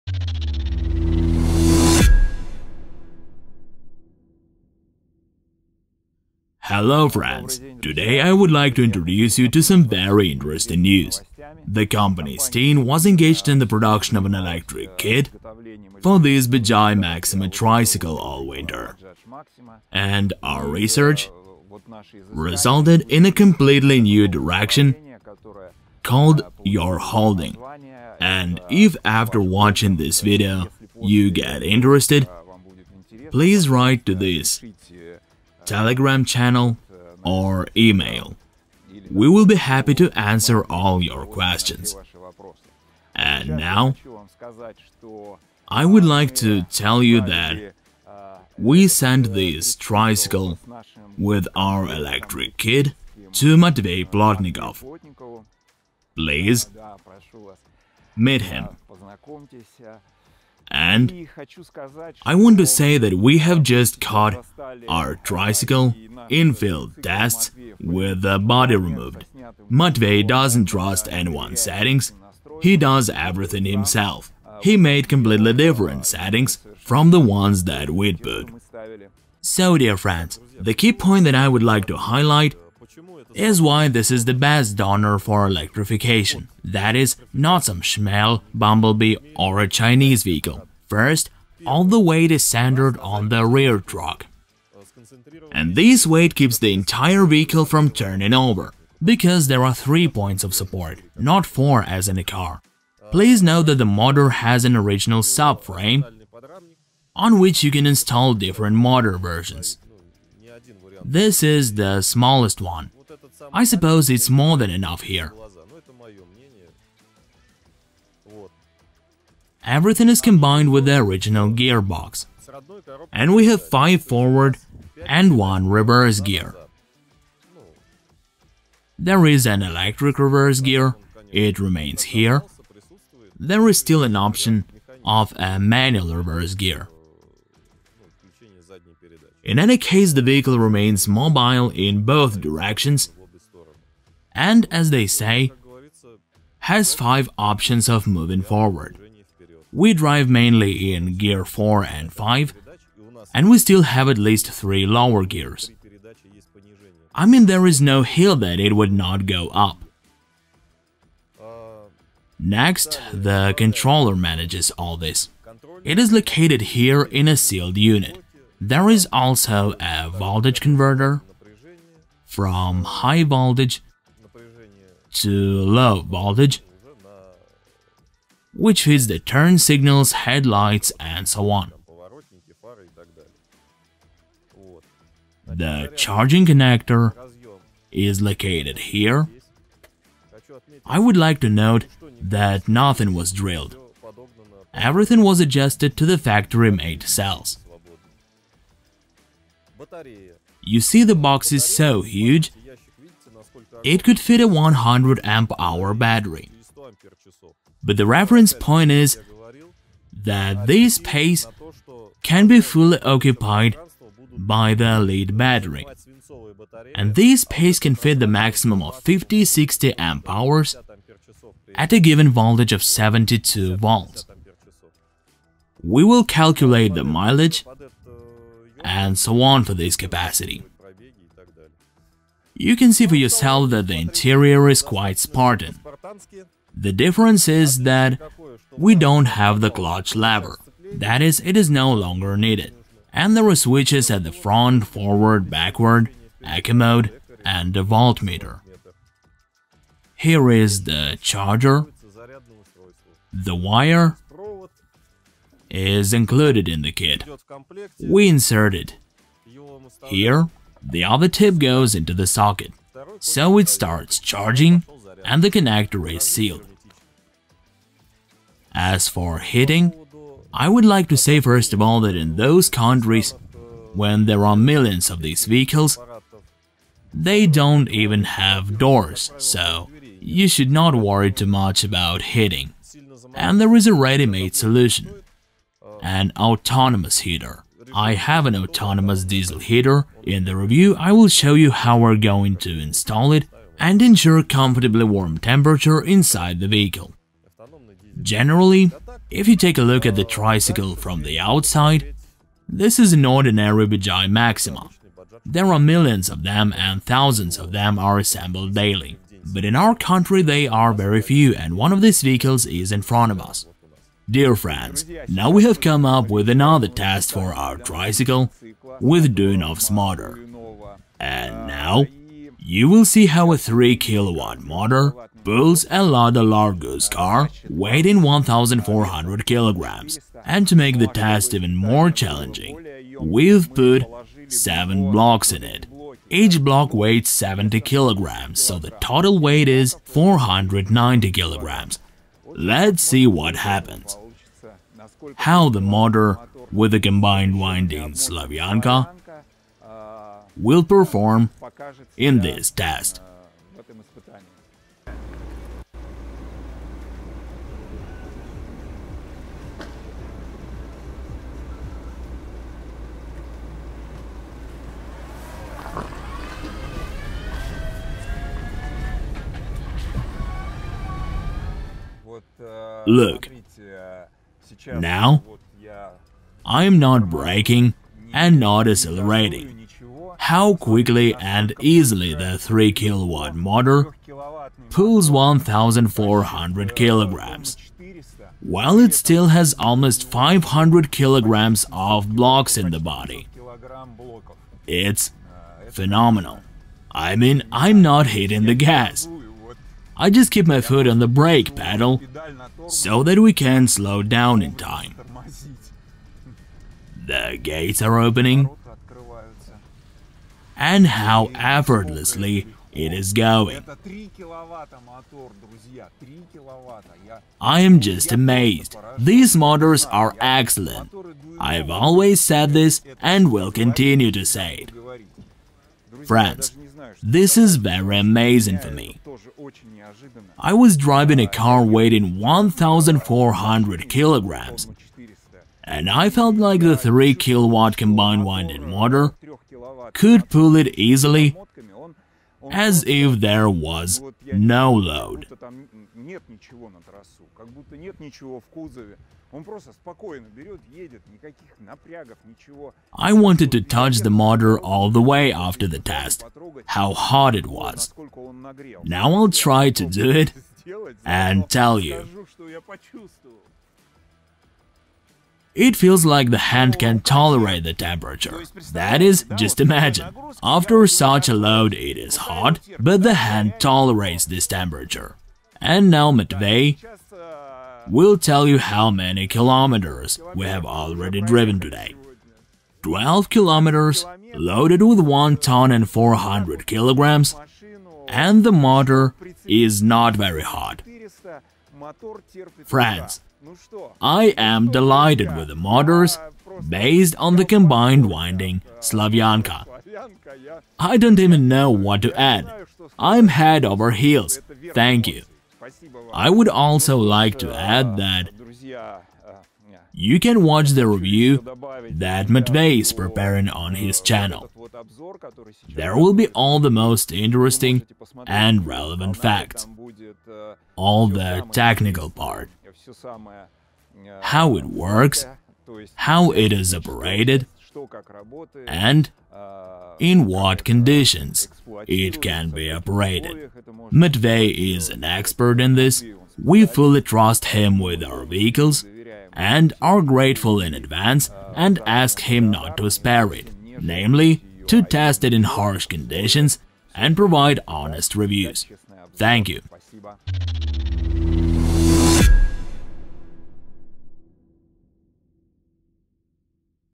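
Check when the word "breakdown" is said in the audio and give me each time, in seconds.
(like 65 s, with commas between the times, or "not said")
not said.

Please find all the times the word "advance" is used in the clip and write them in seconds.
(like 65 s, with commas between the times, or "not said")
540 s.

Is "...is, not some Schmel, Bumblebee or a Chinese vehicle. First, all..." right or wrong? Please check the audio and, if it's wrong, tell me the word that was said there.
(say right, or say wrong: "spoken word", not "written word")
right.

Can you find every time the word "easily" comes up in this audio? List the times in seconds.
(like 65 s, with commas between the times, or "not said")
381 s, 440 s.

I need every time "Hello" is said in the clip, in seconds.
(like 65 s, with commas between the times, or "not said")
6 s.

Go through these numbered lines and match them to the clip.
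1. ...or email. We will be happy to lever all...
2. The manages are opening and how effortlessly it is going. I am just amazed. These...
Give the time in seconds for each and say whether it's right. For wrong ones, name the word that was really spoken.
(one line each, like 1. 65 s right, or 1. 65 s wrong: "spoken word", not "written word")
1. 37 s wrong: "answer", not "lever"
2. 407 s wrong: "gates", not "manages".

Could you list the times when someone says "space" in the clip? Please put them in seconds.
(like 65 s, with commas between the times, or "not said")
210 s, 217 s.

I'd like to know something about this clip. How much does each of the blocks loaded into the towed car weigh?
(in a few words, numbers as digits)
70 kilograms.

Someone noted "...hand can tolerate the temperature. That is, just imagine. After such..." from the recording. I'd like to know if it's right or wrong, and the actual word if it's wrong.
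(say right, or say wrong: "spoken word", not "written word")
right.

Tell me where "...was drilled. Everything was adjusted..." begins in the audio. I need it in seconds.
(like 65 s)
193 s.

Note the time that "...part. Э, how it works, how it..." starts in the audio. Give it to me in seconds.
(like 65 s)
522 s.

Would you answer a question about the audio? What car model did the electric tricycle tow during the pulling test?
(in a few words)
Lada Largus.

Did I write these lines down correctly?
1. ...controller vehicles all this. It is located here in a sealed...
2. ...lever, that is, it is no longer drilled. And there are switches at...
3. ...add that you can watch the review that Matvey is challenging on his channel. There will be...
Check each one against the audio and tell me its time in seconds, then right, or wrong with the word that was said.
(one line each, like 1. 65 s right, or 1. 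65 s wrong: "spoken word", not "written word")
1. 163 s wrong: "manages", not "vehicles"
2. 240 s wrong: "needed", not "drilled"
3. 507 s wrong: "preparing", not "challenging".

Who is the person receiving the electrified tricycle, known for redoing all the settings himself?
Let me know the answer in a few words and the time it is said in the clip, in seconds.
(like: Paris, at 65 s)
Matvey Plotnikov, at 53 s.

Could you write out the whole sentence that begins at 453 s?
I wanted to touch the motor all the way after the test, how hot it was.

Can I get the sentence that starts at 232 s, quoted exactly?
You can see for yourself that the interior is quite Spartan.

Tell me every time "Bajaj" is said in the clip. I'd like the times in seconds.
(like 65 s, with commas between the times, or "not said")
16 s, 303 s.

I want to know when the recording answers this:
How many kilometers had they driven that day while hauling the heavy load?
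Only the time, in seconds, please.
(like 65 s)
483 s.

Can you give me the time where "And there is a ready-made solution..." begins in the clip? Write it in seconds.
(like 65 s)
283 s.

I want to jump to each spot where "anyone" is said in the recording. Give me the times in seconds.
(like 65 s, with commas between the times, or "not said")
71 s.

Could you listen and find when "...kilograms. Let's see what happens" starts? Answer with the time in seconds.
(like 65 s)
341 s.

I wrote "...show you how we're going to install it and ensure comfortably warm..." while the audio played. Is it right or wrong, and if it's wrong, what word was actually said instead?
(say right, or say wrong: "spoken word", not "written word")
right.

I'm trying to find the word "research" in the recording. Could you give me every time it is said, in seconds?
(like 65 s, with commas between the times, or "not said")
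20 s.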